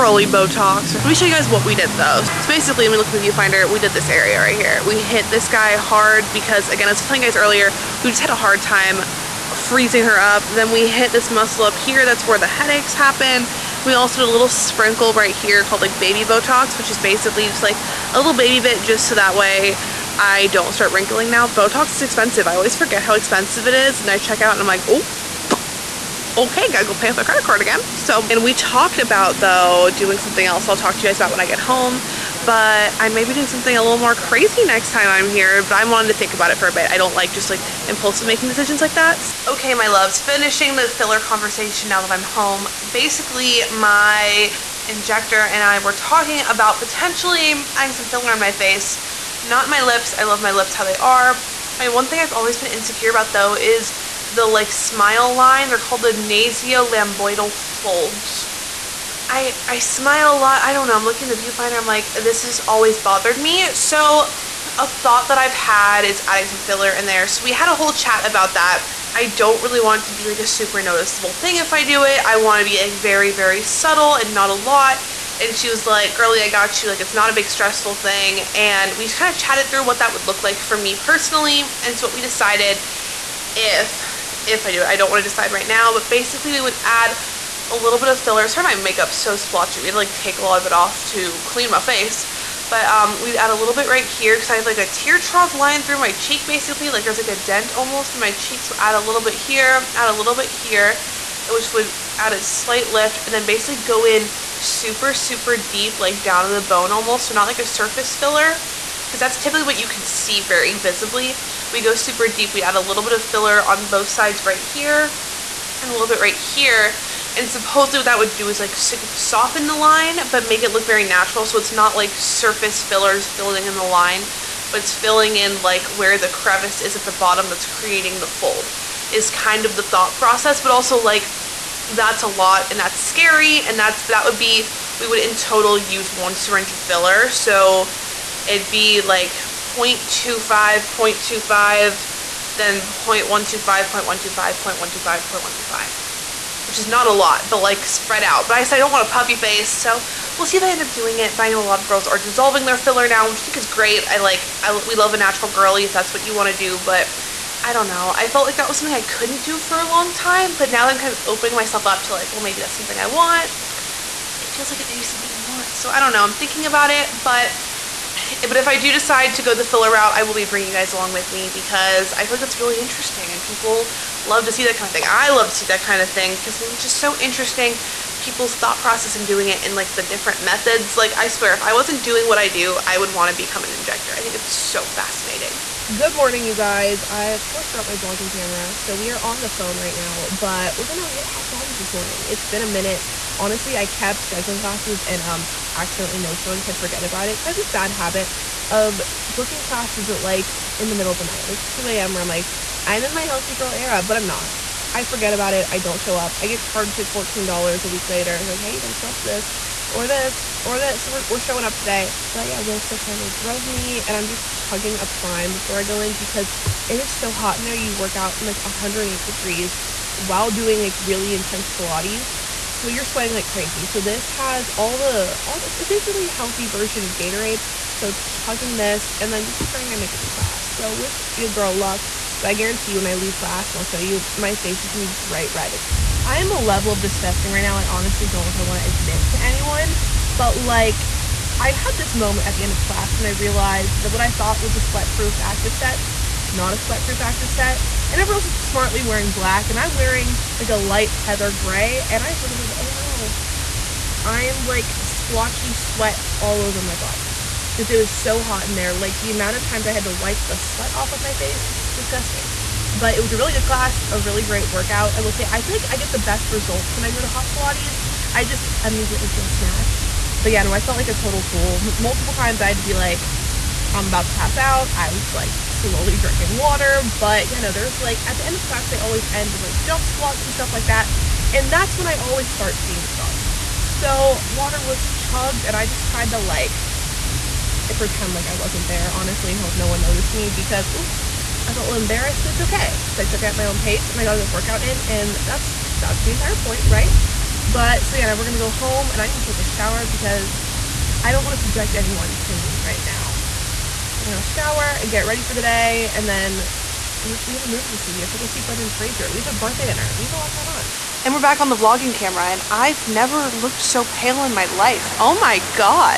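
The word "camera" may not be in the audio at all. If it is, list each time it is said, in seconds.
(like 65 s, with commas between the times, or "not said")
188 s, 312 s.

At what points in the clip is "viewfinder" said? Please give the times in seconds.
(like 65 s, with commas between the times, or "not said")
3 s, 61 s.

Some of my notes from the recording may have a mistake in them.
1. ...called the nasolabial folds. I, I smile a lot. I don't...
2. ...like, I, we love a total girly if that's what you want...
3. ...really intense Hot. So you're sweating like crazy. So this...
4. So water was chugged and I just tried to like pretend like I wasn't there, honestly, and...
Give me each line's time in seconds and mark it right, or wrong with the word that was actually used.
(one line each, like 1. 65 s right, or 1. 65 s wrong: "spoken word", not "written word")
1. 55 s right
2. 154 s wrong: "natural", not "total"
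3. 220 s wrong: "Pilates", not "Hot"
4. 283 s right.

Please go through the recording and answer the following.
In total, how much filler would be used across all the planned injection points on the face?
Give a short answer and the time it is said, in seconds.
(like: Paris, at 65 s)
one syringe, at 136 s.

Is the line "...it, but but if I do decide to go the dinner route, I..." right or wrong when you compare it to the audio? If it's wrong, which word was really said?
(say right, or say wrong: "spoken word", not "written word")
wrong: "filler", not "dinner".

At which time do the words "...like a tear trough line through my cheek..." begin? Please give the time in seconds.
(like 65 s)
94 s.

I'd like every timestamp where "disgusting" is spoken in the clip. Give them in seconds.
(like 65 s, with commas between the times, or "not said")
236 s, 261 s.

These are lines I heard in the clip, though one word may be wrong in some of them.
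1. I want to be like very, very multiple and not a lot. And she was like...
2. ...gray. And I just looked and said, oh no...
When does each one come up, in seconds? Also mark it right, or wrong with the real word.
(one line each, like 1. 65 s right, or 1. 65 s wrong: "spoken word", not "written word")
1. 72 s wrong: "subtle", not "multiple"
2. 251 s right.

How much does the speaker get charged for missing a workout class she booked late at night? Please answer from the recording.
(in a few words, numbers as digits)
$14.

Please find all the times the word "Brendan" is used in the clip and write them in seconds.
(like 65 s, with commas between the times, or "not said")
308 s.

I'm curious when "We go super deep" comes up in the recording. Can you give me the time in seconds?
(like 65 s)
111 s.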